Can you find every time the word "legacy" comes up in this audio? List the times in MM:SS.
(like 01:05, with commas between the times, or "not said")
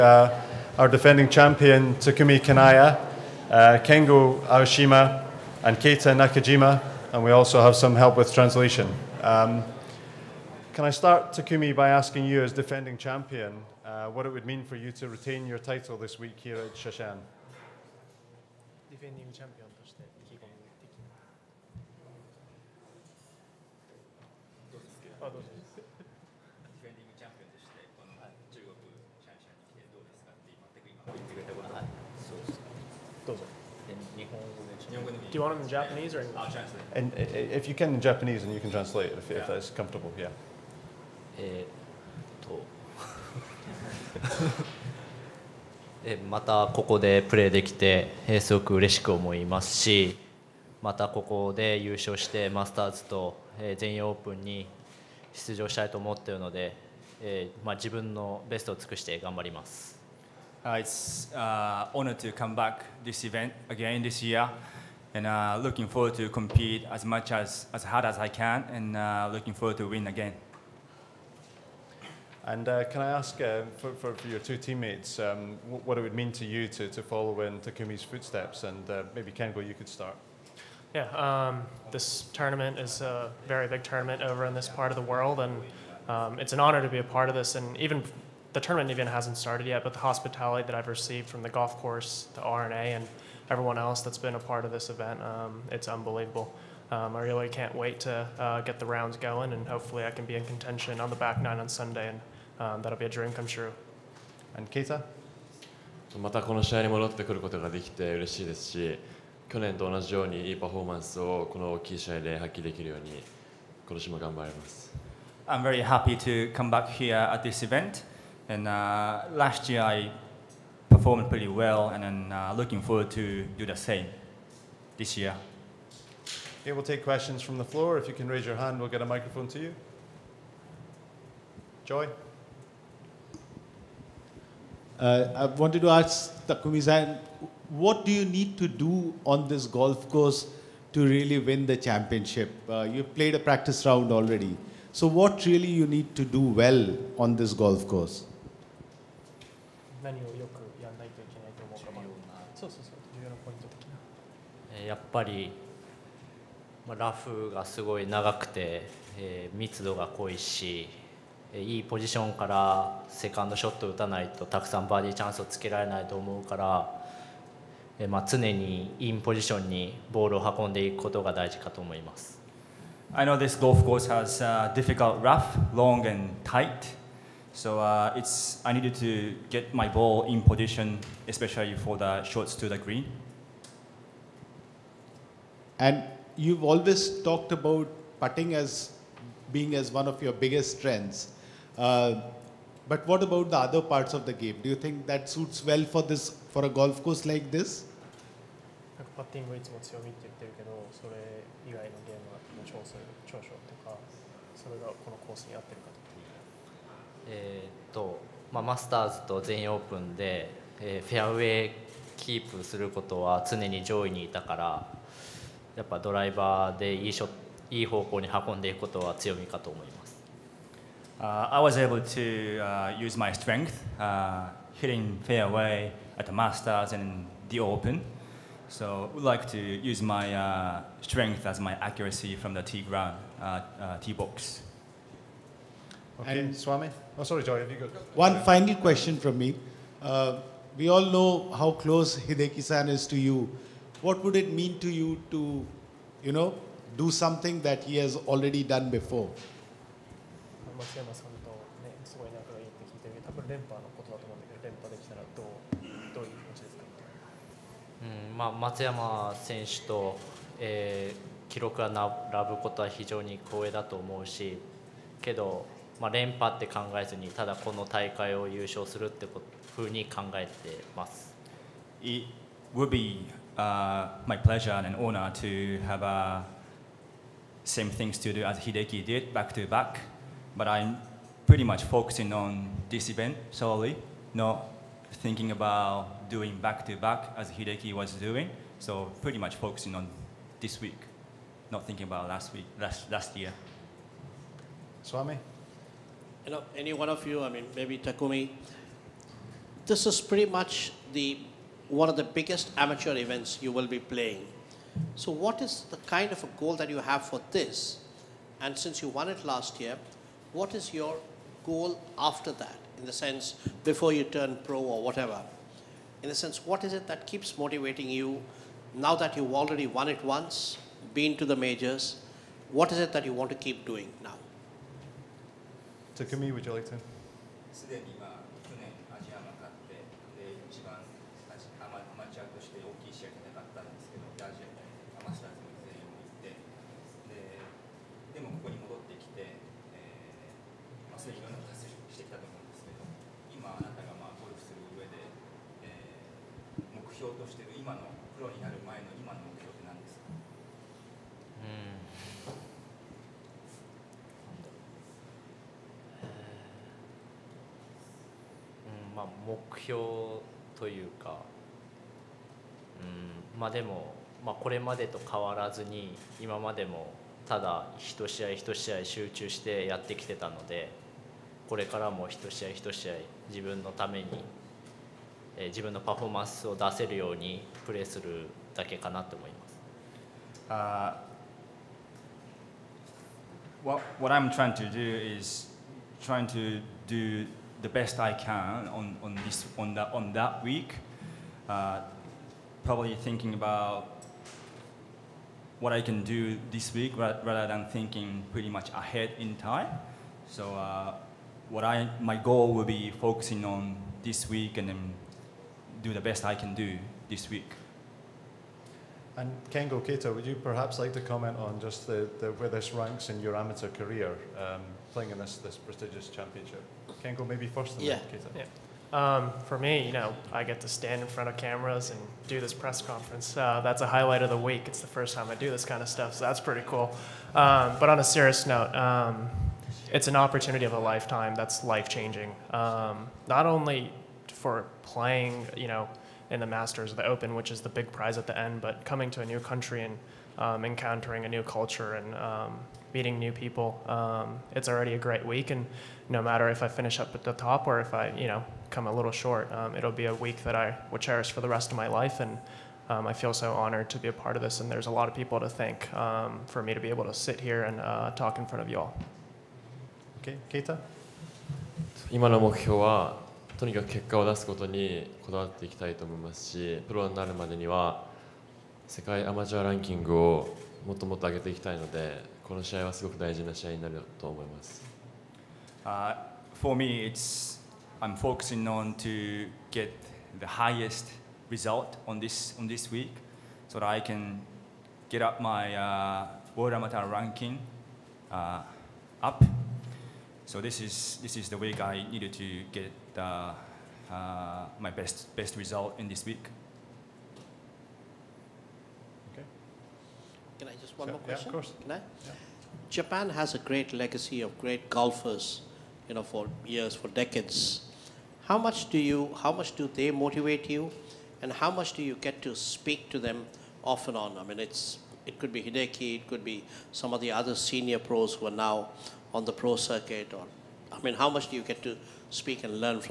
08:24.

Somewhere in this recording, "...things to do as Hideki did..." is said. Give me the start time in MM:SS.
04:37.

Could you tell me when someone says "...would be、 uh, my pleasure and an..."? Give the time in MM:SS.
04:32.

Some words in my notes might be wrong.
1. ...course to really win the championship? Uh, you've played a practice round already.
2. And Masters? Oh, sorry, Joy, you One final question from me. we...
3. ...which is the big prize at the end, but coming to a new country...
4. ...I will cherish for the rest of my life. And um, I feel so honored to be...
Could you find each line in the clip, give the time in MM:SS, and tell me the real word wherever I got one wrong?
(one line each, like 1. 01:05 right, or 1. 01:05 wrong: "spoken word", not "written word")
1. 02:20 right
2. 03:56 wrong: "Swami", not "Masters"
3. 07:17 right
4. 07:30 right.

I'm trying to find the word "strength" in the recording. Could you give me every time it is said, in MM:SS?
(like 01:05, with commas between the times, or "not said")
03:10, 03:43, 03:51.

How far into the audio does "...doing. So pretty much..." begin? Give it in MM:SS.
04:48.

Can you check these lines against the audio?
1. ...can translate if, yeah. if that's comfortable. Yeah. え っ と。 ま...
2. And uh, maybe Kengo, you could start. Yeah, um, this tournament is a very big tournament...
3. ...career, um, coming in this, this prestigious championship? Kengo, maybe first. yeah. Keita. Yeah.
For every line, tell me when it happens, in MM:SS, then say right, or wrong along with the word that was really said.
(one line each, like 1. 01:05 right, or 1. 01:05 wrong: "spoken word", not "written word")
1. 00:38 right
2. 01:18 right
3. 06:53 wrong: "playing", not "coming".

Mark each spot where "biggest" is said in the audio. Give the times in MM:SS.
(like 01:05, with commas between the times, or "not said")
03:10, 05:02.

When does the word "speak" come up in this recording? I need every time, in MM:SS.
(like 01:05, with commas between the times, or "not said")
08:32, 08:42.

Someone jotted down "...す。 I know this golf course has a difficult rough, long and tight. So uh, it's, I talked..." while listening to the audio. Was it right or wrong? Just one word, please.
wrong.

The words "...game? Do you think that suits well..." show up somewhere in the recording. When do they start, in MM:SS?
03:14.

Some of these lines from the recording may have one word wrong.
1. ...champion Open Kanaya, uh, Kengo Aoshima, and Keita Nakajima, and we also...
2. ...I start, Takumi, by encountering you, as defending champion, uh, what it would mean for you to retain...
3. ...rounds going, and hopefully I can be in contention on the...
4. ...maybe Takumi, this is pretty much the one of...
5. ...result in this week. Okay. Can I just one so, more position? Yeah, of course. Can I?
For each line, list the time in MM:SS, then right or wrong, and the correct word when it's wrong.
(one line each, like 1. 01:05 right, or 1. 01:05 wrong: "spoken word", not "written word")
1. 00:01 wrong: "Takumi", not "Open"
2. 00:10 wrong: "asking", not "encountering"
3. 01:38 right
4. 04:57 right
5. 08:15 wrong: "question", not "position".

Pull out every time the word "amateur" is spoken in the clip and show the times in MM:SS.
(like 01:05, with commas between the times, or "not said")
05:02, 06:53, 08:06.